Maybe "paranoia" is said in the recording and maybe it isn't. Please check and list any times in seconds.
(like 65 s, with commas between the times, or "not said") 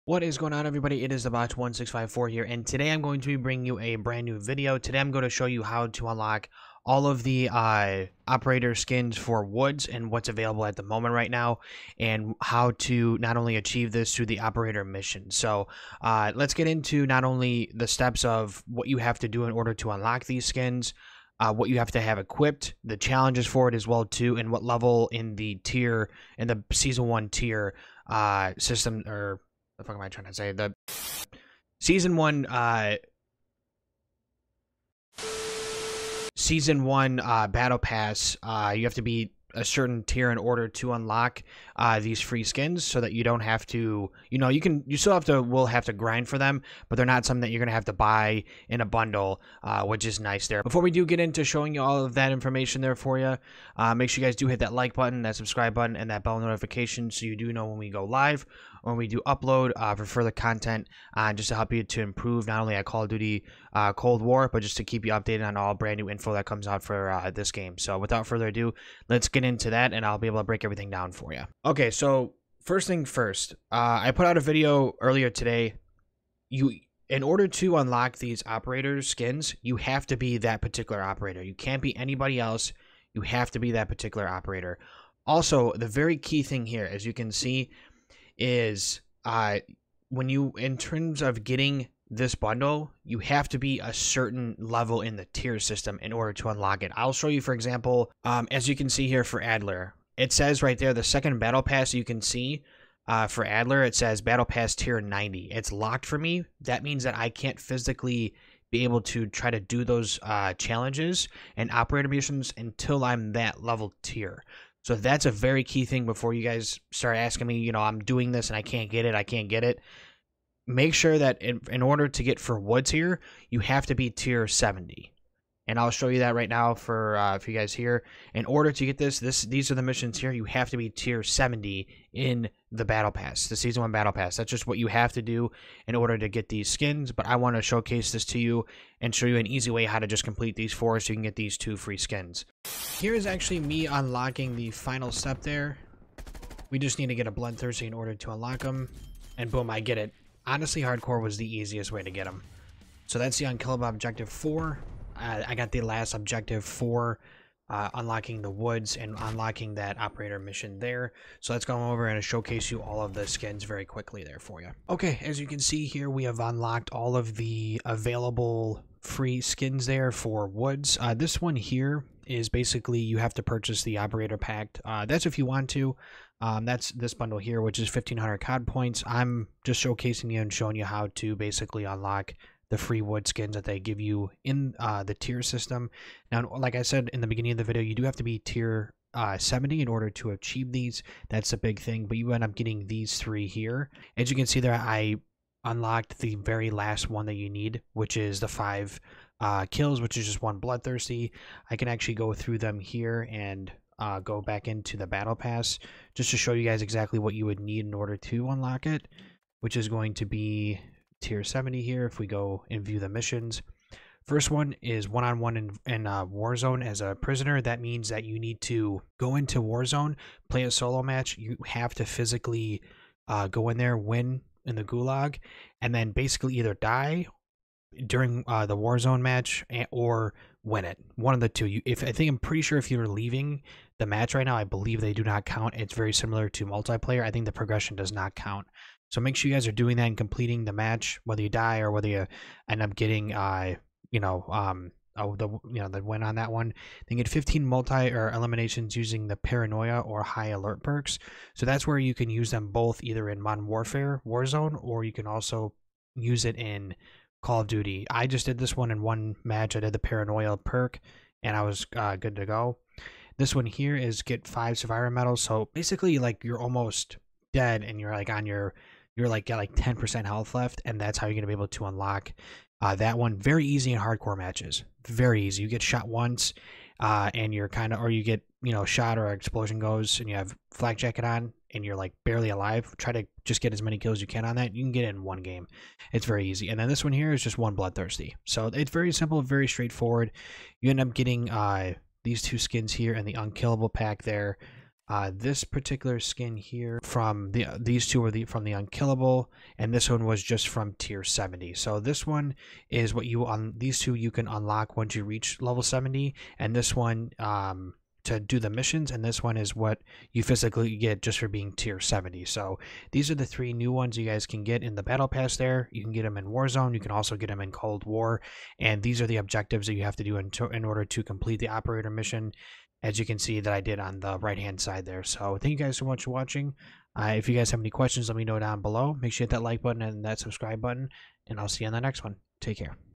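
249 s, 259 s.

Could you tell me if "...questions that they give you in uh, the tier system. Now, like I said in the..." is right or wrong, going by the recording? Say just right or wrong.
wrong.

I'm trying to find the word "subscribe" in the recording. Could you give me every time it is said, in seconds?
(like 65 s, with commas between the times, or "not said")
55 s, 330 s.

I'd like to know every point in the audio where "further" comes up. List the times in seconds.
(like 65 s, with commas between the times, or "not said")
60 s, 68 s.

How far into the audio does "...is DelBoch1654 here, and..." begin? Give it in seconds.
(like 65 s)
1 s.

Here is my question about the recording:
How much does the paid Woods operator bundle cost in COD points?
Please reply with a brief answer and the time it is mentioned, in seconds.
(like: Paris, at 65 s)
1500, at 177 s.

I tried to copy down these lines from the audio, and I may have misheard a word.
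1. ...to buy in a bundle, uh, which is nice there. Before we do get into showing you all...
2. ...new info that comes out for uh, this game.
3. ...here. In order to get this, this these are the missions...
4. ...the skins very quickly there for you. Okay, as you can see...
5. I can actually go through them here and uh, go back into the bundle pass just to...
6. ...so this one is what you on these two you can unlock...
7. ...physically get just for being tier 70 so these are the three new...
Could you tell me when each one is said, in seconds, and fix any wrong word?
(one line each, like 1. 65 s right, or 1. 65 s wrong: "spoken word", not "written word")
1. 47 s right
2. 65 s right
3. 127 s right
4. 163 s right
5. 201 s wrong: "battle", not "bundle"
6. 301 s right
7. 310 s right.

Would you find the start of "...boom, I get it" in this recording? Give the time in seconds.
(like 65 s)
149 s.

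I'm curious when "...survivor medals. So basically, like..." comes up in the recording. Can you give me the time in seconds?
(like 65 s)
264 s.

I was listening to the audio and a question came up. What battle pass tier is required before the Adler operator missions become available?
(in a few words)
90.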